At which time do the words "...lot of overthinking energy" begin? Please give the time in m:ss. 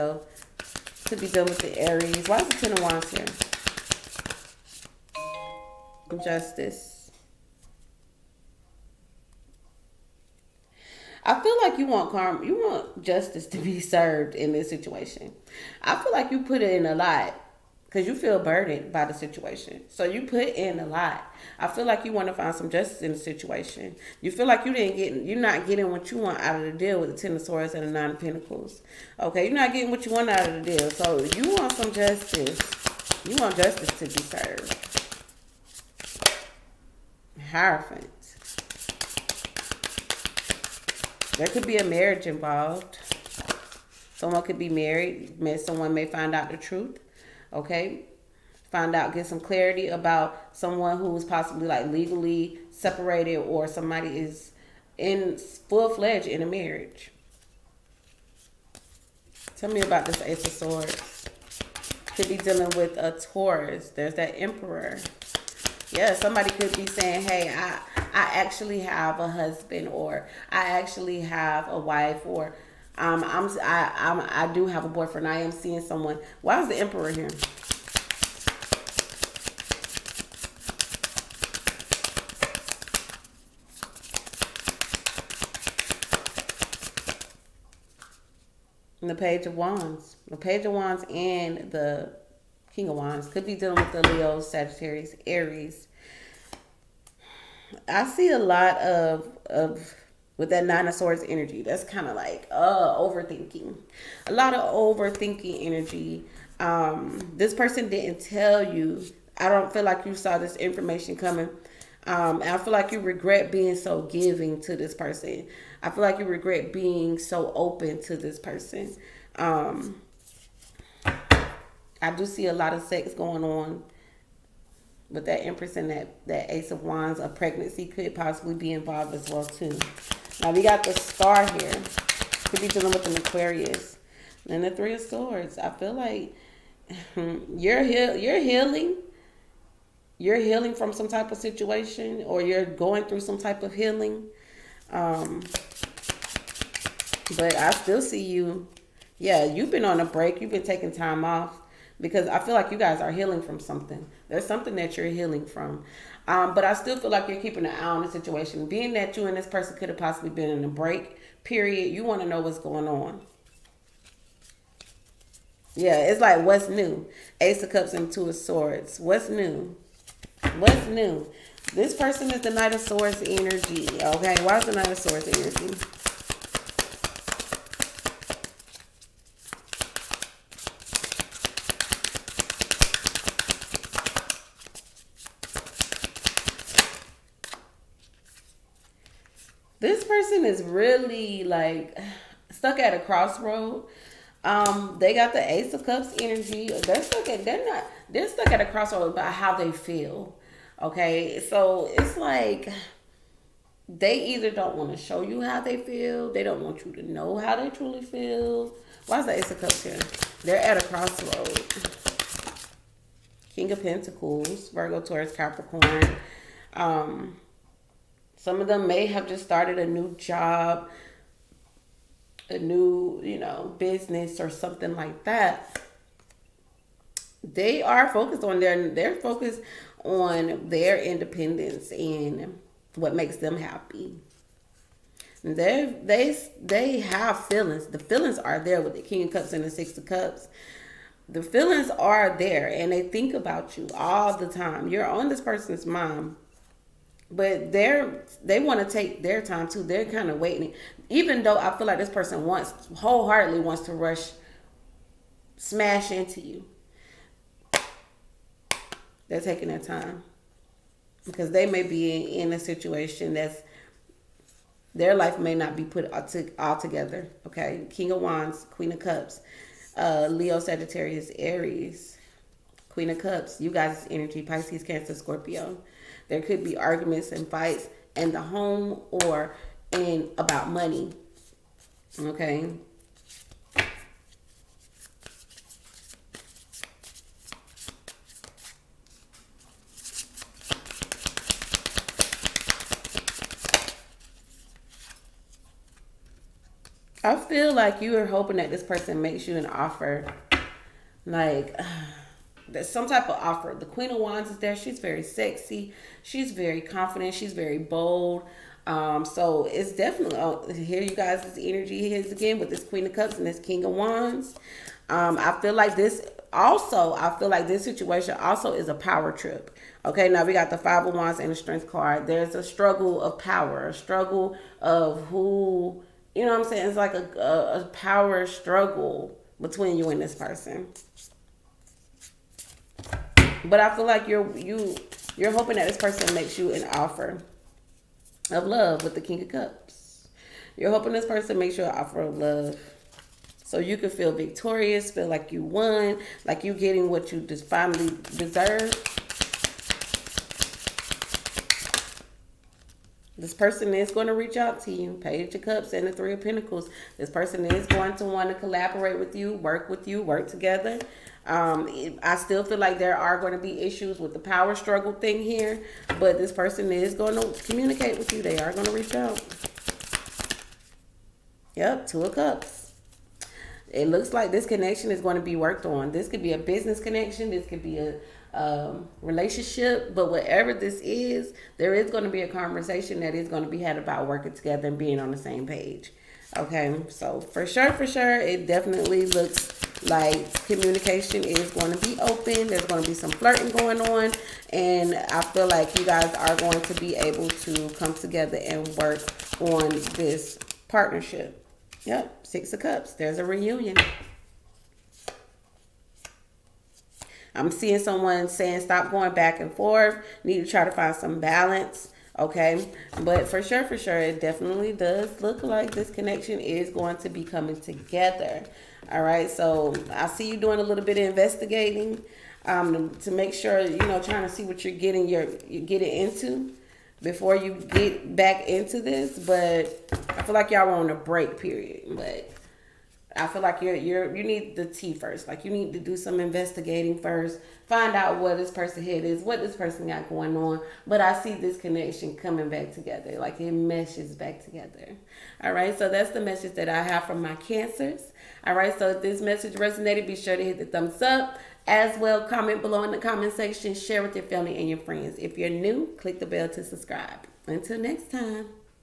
1:44.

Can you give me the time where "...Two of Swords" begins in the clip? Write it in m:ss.
2:48.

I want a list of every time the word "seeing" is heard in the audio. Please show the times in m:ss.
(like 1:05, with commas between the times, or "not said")
1:15, 6:47.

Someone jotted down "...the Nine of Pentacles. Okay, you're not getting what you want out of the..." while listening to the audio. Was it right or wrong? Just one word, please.
right.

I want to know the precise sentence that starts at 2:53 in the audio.
Okay, why is the Knight of Swords energy?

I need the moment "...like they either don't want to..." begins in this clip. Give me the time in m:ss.
3:22.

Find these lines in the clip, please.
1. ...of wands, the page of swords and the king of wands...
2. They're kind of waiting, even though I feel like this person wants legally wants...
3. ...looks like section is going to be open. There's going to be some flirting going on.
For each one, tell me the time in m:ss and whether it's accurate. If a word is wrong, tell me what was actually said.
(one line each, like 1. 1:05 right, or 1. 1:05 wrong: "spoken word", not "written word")
1. 1:29 wrong: "wands", not "swords"
2. 4:09 wrong: "wholeheartedly", not "legally"
3. 6:29 wrong: "communication", not "section".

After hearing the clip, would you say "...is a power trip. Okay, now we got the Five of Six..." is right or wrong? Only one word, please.
wrong.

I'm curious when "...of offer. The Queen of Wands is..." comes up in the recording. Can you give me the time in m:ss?
5:03.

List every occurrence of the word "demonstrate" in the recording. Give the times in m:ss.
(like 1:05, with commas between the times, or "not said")
not said.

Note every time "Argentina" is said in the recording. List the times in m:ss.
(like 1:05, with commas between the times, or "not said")
not said.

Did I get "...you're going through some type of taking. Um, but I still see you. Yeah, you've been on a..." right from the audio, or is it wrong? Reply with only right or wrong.
wrong.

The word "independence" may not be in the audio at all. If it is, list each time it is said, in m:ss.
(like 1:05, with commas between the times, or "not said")
3:50.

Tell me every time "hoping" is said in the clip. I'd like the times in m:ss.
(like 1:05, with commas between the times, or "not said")
4:58, 5:35, 5:40.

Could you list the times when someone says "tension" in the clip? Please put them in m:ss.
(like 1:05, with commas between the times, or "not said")
not said.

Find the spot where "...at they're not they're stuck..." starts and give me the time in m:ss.
3:17.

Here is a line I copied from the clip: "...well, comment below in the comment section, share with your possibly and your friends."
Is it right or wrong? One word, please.
wrong.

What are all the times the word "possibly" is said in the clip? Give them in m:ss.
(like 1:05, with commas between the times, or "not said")
0:51, 2:08, 2:39.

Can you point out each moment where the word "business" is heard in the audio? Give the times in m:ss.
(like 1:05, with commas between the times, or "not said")
3:43, 6:16.